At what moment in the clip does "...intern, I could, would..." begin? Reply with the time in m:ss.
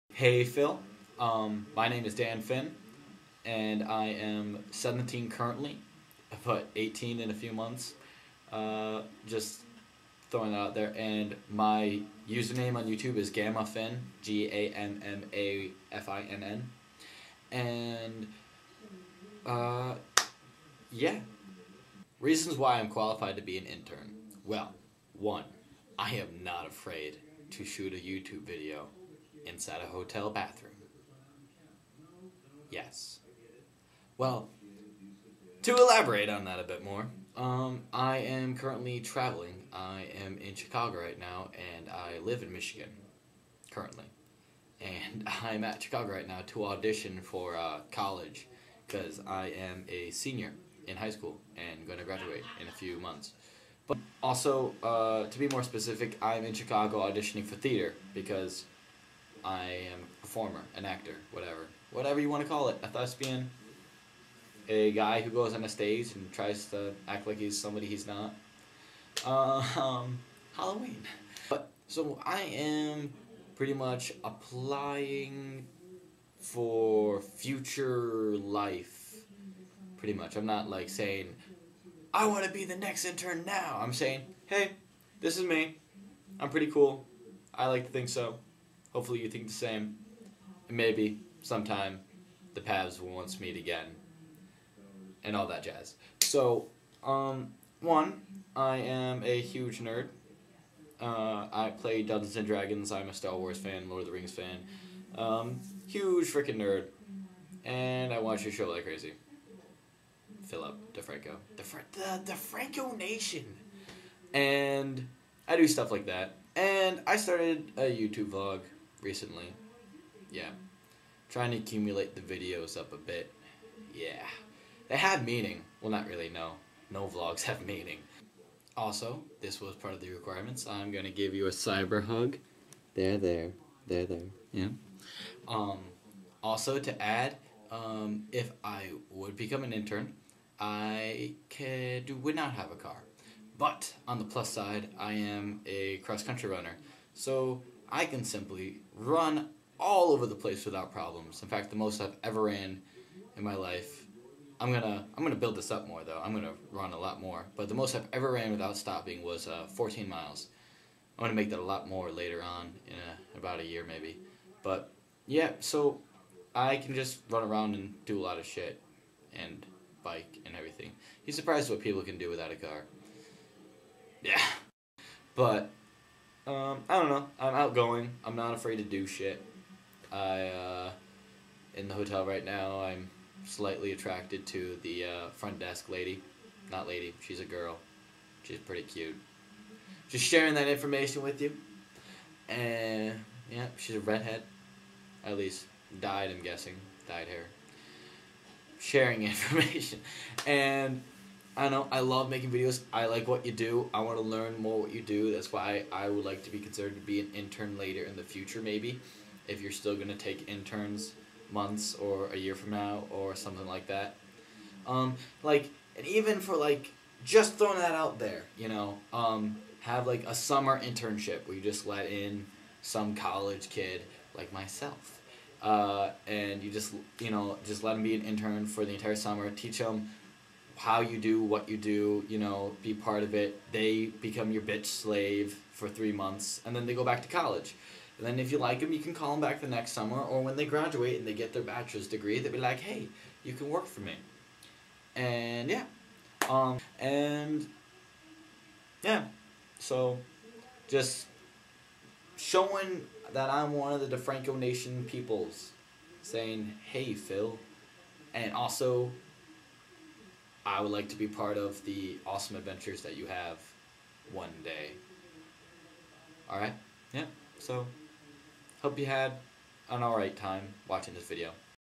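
2:19.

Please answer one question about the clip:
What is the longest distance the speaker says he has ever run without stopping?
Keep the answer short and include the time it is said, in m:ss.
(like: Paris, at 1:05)
14 miles, at 2:39.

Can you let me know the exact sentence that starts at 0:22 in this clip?
Reasons why I'm qualified to be an intern.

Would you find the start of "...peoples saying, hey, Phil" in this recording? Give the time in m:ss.
4:15.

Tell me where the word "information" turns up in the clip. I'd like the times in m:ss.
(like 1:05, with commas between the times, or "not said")
3:10, 3:19.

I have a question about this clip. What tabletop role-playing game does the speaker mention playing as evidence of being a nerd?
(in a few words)
Dungeons and Dragons.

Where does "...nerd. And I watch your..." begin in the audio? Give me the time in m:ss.
1:46.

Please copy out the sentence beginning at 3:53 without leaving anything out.
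They become your bitch slave for three months, and then they go back to college.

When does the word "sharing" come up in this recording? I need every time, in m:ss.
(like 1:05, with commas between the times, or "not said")
3:10, 3:18.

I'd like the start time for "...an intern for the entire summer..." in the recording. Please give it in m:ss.
3:48.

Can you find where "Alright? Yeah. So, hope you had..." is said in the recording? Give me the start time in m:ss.
4:26.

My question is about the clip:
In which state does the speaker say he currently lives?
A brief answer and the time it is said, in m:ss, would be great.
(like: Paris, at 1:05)
Michigan, at 0:42.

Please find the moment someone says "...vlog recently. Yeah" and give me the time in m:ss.
1:58.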